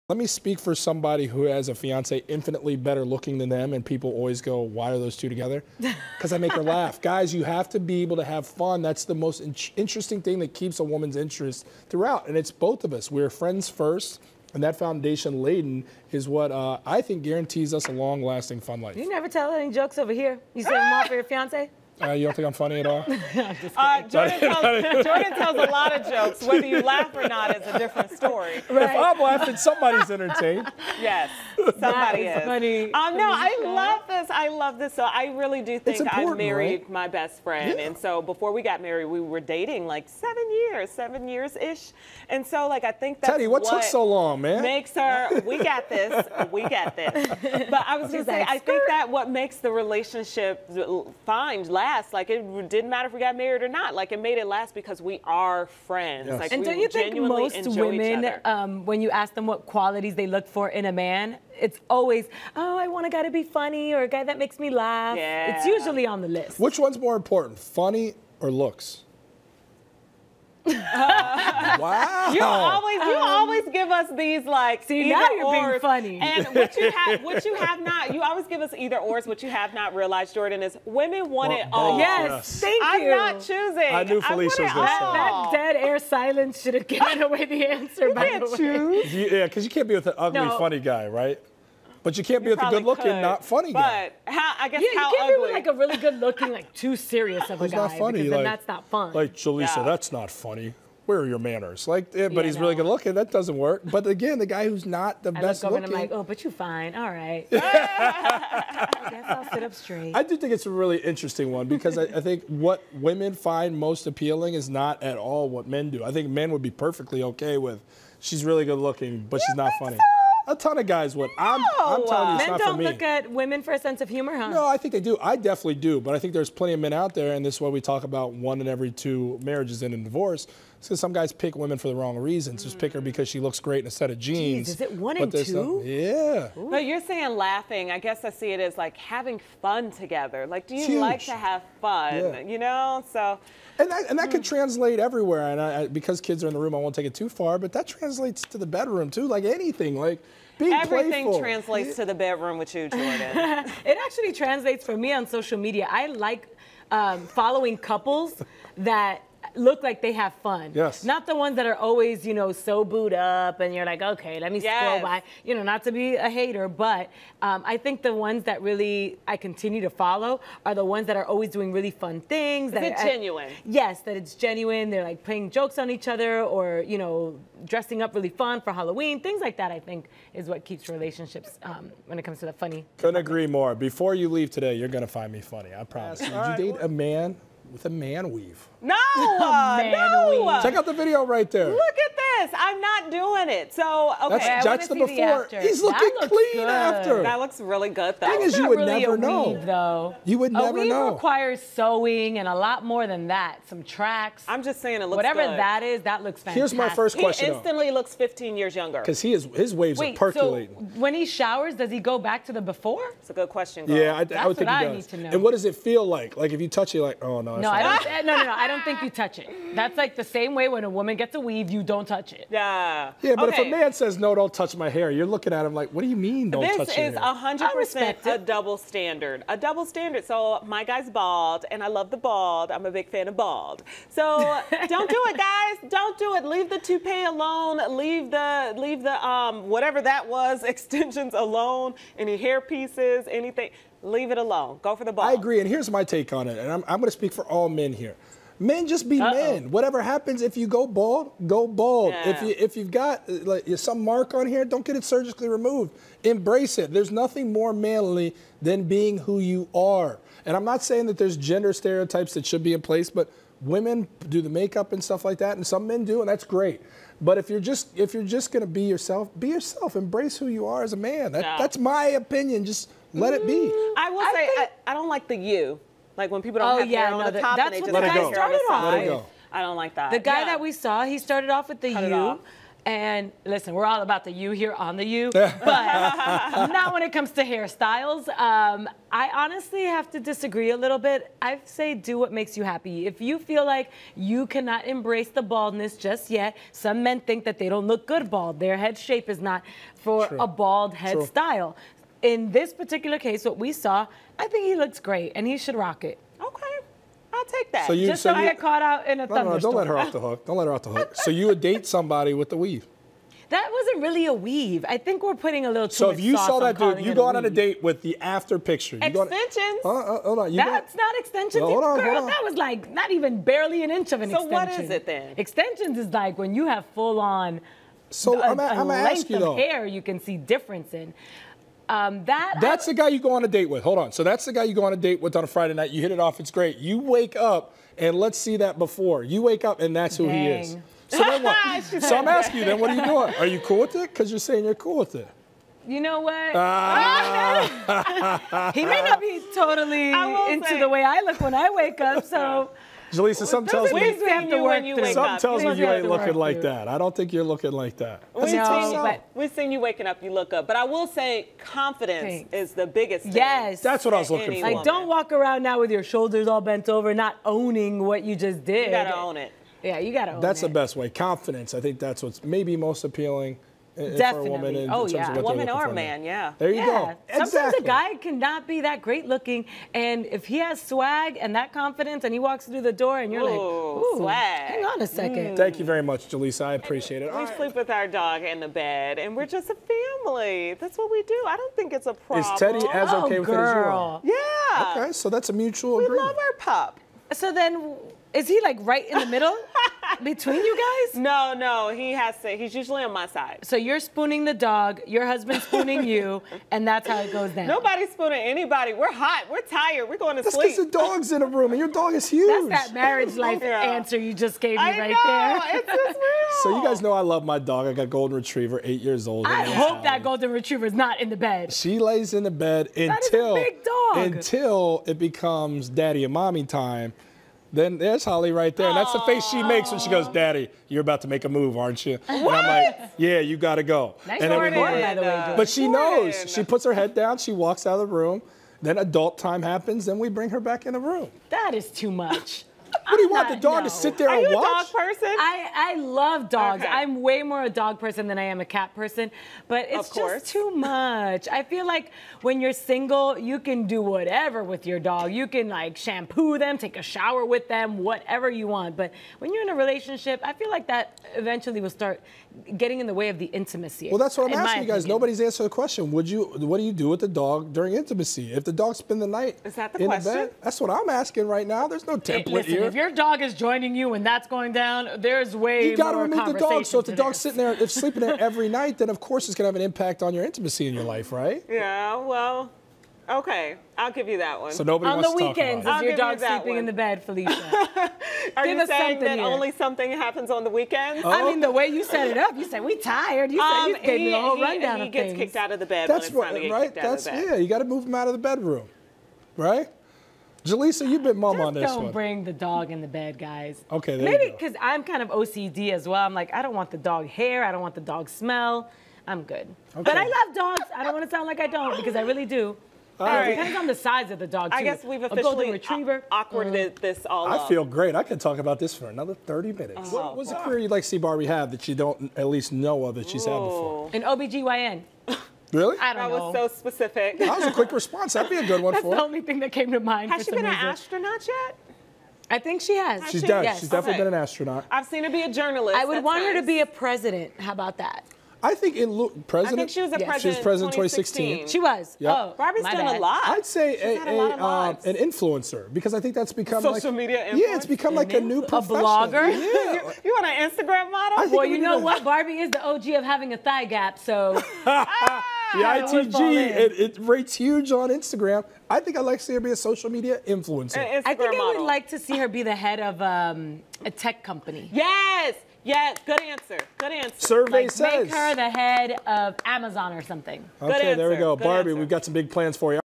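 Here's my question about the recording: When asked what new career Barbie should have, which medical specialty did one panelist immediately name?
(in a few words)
OBGYN.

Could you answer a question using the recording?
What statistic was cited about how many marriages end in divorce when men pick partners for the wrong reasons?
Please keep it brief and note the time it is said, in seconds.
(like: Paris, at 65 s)
One in every two, at 128 s.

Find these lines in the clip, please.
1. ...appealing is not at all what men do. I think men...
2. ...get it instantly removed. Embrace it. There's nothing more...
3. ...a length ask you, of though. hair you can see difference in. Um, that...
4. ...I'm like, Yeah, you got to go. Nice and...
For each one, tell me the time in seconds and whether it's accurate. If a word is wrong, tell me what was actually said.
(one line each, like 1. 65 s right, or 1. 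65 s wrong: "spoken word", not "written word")
1. 114 s right
2. 254 s wrong: "surgically", not "instantly"
3. 328 s right
4. 432 s right.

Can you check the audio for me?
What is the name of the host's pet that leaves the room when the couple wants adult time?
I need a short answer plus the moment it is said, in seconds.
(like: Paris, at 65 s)
Holly, at 428 s.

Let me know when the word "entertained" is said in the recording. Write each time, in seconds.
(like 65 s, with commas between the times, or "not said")
30 s.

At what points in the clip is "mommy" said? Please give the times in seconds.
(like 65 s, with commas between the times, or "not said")
426 s.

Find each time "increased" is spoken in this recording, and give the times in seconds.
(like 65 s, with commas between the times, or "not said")
not said.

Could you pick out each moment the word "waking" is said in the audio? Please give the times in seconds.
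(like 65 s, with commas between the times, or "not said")
359 s.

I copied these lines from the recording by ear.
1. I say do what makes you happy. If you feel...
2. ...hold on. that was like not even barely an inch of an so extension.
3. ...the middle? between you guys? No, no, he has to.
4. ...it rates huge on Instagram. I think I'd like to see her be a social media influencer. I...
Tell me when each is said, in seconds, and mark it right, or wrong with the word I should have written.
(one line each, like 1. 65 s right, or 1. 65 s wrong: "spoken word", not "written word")
1. 291 s right
2. 322 s right
3. 399 s right
4. 556 s right.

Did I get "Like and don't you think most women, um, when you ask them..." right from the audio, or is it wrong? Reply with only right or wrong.
right.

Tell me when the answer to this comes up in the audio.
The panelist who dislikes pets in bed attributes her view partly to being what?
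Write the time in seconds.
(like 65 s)
505 s.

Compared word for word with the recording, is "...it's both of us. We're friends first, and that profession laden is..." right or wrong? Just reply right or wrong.
wrong.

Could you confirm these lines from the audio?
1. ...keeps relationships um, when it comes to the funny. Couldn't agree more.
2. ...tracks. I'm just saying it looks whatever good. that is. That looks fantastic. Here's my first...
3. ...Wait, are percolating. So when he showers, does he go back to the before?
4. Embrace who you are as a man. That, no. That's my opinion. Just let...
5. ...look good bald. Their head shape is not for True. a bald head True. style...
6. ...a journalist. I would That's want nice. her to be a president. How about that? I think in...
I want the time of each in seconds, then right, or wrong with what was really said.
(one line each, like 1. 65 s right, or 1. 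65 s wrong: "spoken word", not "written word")
1. 180 s right
2. 203 s right
3. 209 s right
4. 269 s right
5. 297 s right
6. 535 s right.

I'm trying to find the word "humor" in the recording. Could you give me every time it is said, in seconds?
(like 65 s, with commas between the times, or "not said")
124 s.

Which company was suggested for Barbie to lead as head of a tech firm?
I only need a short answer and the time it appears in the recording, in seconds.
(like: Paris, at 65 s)
Amazon, at 569 s.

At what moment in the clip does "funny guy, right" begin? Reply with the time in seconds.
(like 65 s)
90 s.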